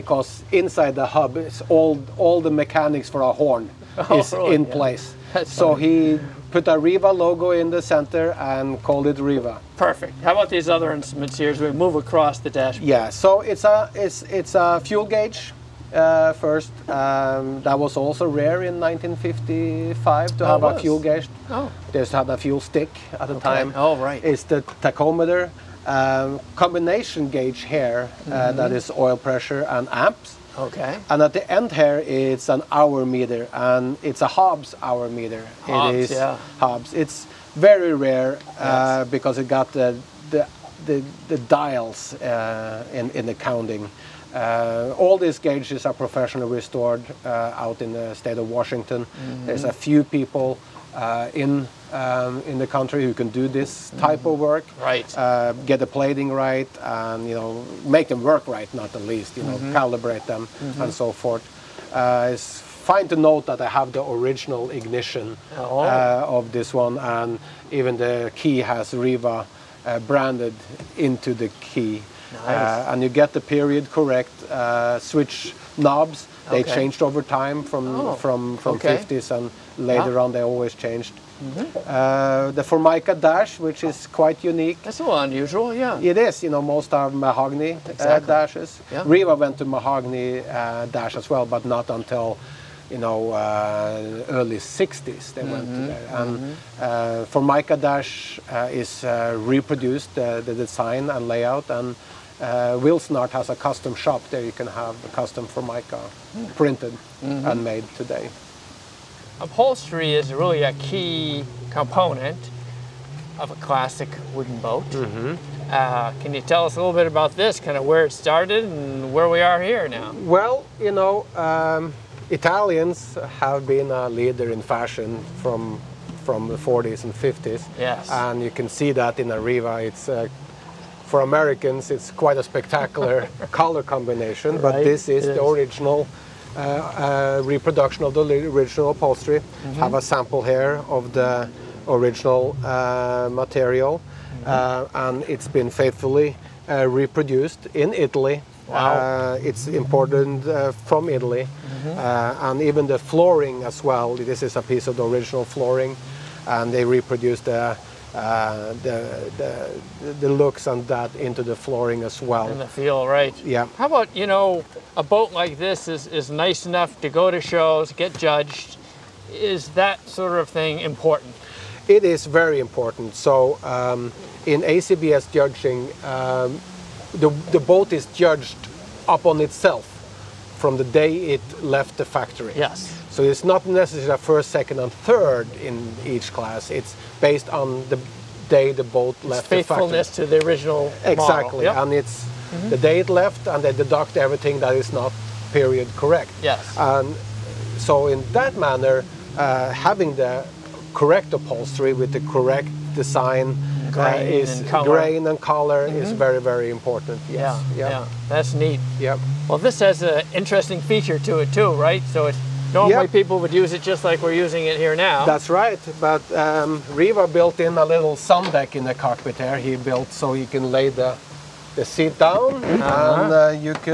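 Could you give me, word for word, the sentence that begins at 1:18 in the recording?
50s and later on they always changed.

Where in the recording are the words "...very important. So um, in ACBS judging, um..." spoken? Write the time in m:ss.
2:52.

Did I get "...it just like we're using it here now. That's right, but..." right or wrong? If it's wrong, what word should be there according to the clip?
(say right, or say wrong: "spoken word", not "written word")
right.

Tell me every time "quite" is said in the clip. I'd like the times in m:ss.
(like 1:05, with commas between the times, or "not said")
1:24, 2:12.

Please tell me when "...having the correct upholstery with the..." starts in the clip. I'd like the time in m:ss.
3:19.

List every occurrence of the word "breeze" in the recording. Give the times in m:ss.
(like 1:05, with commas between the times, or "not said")
not said.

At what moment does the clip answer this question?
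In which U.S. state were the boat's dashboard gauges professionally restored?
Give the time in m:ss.
0:48.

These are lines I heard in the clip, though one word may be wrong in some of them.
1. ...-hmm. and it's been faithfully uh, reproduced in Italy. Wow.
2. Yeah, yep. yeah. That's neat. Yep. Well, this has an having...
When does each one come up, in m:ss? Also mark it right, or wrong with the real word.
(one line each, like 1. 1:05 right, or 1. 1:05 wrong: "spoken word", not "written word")
1. 2:24 right
2. 3:27 wrong: "interesting", not "having".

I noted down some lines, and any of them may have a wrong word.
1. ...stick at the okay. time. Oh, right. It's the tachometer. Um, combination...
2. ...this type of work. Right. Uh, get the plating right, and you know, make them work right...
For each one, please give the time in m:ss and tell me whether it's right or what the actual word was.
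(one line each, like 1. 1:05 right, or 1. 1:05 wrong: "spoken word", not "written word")
1. 0:22 right
2. 0:53 right.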